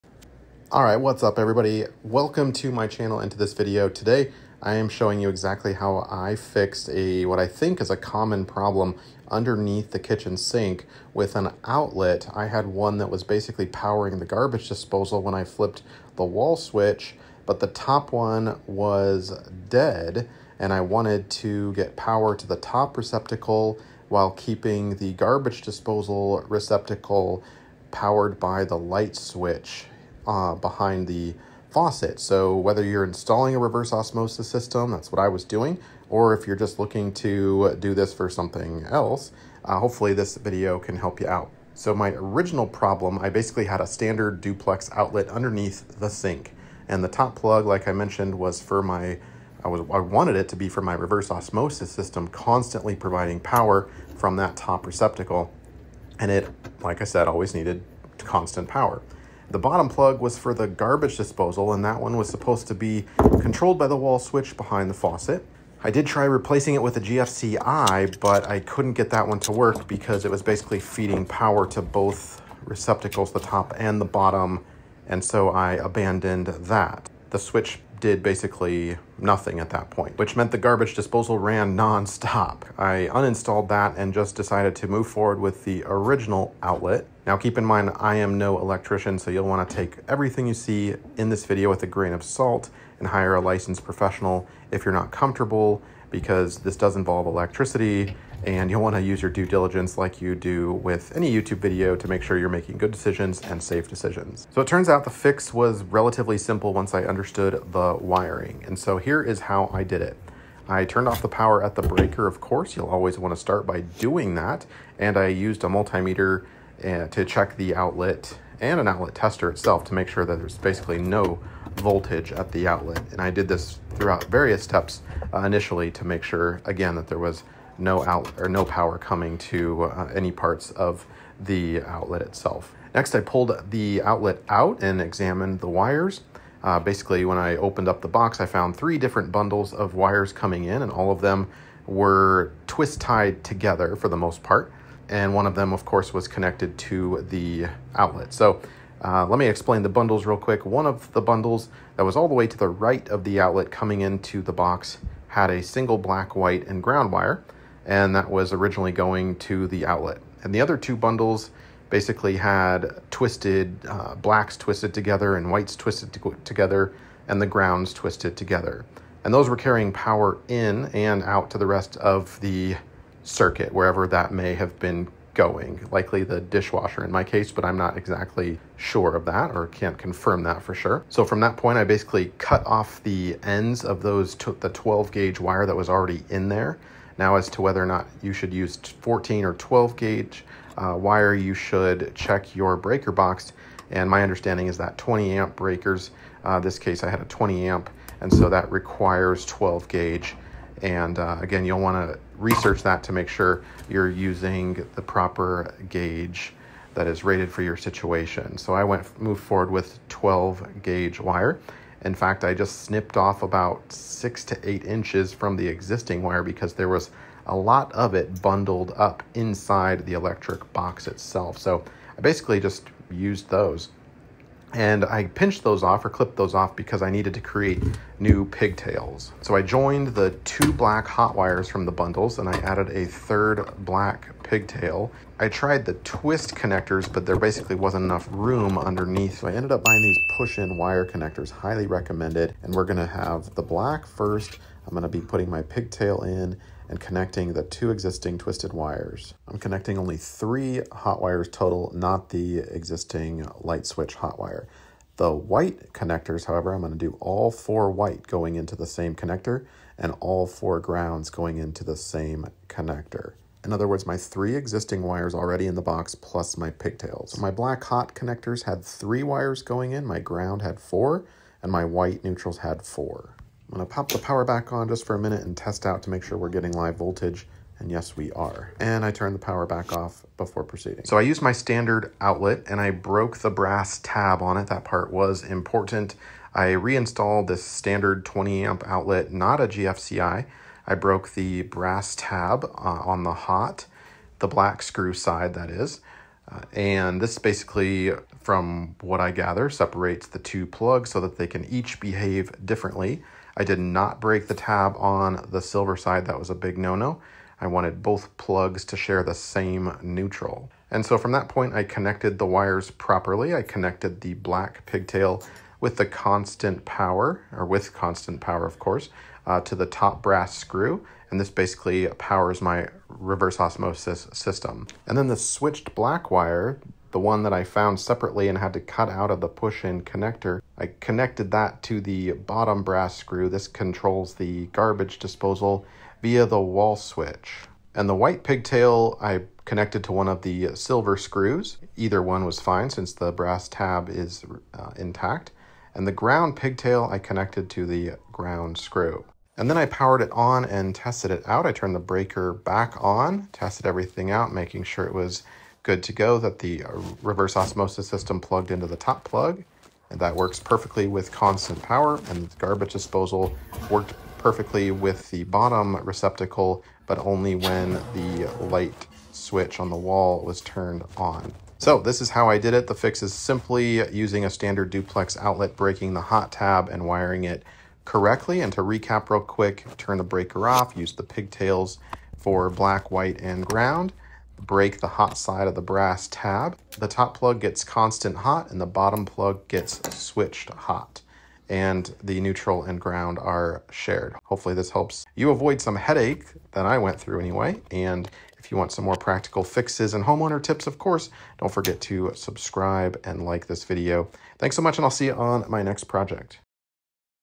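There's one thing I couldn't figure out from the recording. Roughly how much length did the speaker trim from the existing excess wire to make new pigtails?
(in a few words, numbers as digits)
6 to 8 inches.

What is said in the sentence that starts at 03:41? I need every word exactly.
So I basically just used those.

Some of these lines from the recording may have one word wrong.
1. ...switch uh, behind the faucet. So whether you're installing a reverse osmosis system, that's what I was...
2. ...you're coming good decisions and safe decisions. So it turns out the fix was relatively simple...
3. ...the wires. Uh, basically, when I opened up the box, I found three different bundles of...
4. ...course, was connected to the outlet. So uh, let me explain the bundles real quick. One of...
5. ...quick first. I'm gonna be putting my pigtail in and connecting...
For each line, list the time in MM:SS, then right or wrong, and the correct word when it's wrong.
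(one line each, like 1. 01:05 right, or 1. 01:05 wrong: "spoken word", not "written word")
1. 00:29 right
2. 01:42 wrong: "making", not "coming"
3. 02:15 right
4. 02:25 right
5. 04:03 wrong: "black", not "quick".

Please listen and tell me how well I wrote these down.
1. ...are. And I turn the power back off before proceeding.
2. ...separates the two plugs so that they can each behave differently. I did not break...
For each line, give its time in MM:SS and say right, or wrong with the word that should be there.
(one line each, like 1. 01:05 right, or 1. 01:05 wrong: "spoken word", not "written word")
1. 04:38 right
2. 04:59 right.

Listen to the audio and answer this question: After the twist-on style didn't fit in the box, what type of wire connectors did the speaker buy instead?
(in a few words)
push-in wire connectors.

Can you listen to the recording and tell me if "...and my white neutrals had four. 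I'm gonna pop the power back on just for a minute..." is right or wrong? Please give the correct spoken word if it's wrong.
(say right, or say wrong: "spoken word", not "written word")
right.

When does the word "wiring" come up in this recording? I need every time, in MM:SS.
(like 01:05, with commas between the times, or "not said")
01:47, 06:17.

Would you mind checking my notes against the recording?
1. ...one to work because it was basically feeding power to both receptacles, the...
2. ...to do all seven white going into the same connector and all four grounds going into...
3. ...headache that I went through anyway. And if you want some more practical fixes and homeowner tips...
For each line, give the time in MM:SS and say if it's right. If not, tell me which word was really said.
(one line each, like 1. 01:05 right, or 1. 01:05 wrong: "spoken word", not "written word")
1. 01:09 right
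2. 04:16 wrong: "four", not "seven"
3. 06:35 right.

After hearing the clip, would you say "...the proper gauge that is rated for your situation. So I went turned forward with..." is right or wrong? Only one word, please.
wrong.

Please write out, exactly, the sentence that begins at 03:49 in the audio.
So I joined the two black hot wires from the bundles and I added a third black pigtail.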